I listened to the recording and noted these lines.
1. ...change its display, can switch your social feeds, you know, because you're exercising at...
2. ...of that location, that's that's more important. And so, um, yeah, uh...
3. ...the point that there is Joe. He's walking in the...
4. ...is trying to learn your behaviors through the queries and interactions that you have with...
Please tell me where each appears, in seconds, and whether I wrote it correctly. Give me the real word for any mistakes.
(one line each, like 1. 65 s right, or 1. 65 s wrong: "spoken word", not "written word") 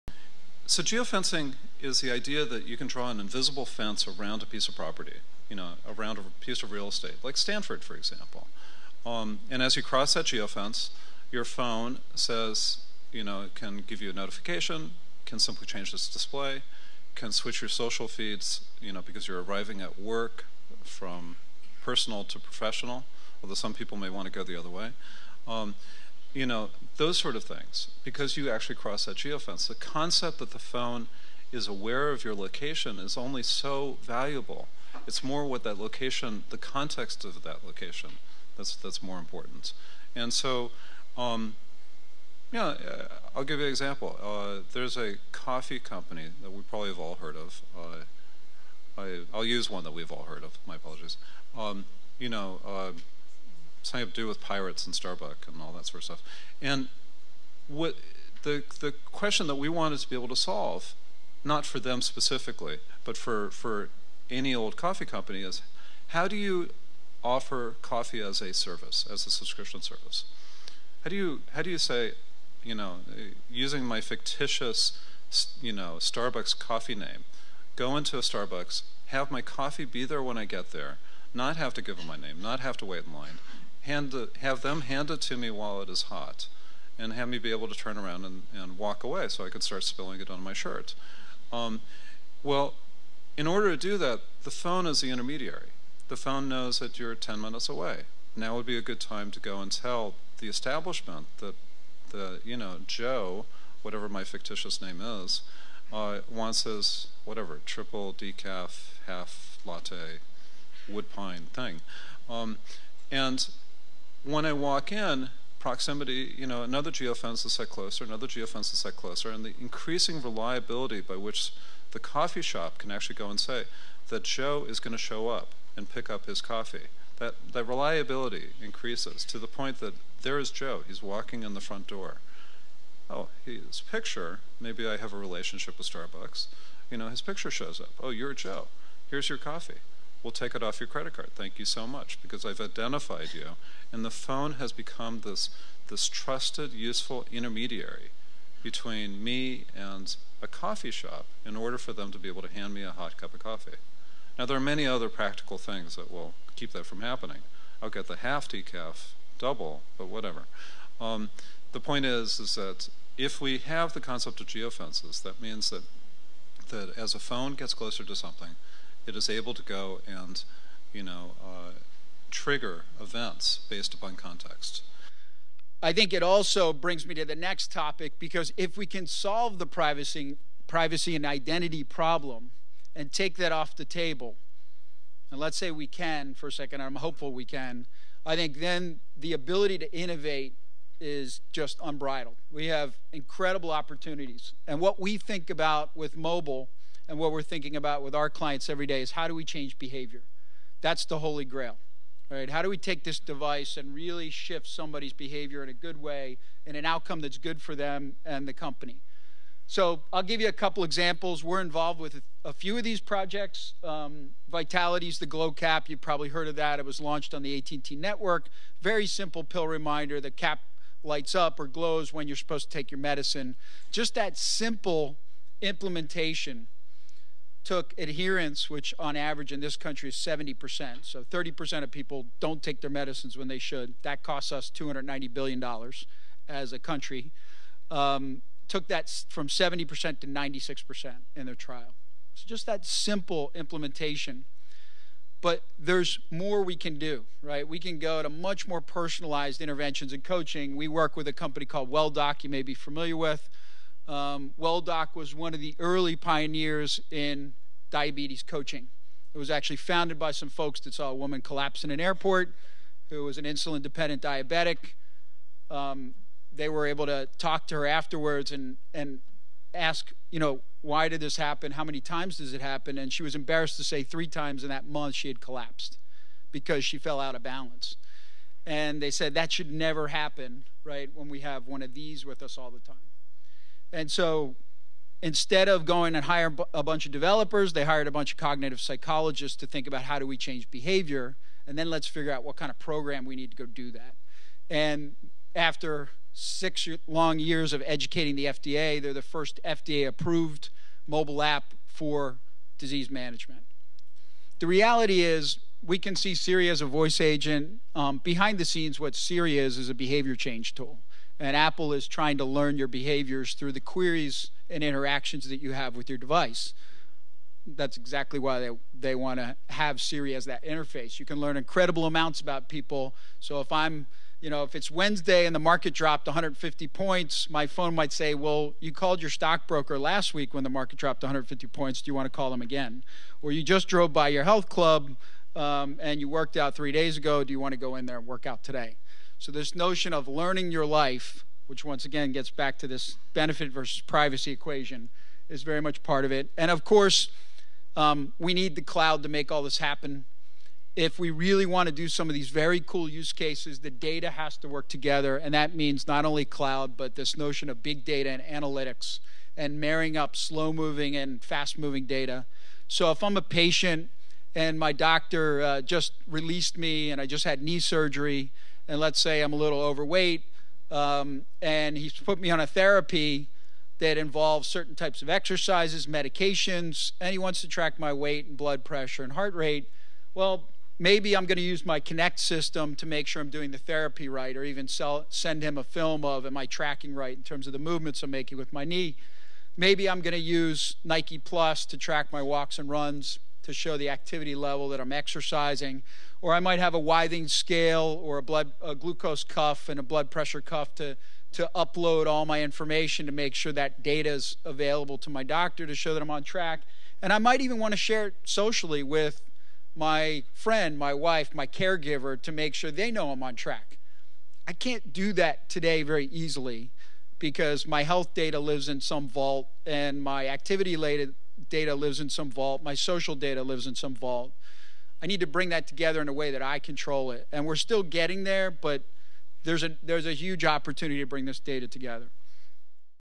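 1. 15 s wrong: "arriving", not "exercising"
2. 37 s right
3. 129 s right
4. 311 s right.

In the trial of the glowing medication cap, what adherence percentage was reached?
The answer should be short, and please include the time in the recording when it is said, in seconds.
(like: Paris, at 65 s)
96%, at 240 s.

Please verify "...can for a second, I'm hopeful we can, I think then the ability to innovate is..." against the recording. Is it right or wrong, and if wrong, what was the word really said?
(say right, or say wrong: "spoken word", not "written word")
right.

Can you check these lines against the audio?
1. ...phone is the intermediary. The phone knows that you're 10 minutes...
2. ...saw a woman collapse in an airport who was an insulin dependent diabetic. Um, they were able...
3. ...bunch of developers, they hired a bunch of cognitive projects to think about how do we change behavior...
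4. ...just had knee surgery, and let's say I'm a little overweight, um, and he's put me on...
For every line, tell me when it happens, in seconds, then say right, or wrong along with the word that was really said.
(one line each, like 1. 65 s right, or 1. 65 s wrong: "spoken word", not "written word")
1. 94 s right
2. 260 s right
3. 286 s wrong: "psychologists", not "projects"
4. 367 s right.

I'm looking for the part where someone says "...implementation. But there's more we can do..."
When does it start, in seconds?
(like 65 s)
243 s.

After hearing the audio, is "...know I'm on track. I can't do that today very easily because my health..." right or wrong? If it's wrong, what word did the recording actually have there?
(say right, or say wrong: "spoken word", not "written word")
right.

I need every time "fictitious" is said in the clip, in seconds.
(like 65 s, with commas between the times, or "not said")
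74 s, 104 s.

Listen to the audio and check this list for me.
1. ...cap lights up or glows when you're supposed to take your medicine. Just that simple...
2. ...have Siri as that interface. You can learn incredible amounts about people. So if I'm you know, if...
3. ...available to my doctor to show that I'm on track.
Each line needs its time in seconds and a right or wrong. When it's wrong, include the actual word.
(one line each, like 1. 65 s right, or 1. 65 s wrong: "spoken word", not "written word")
1. 220 s right
2. 319 s right
3. 404 s right.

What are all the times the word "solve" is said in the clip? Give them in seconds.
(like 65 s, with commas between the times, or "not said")
60 s, 179 s.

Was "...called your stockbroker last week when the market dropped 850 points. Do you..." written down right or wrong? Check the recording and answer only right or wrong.
wrong.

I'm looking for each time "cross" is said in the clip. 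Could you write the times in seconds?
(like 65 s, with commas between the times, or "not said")
9 s, 28 s.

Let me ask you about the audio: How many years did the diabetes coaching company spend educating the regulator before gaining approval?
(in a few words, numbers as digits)
6.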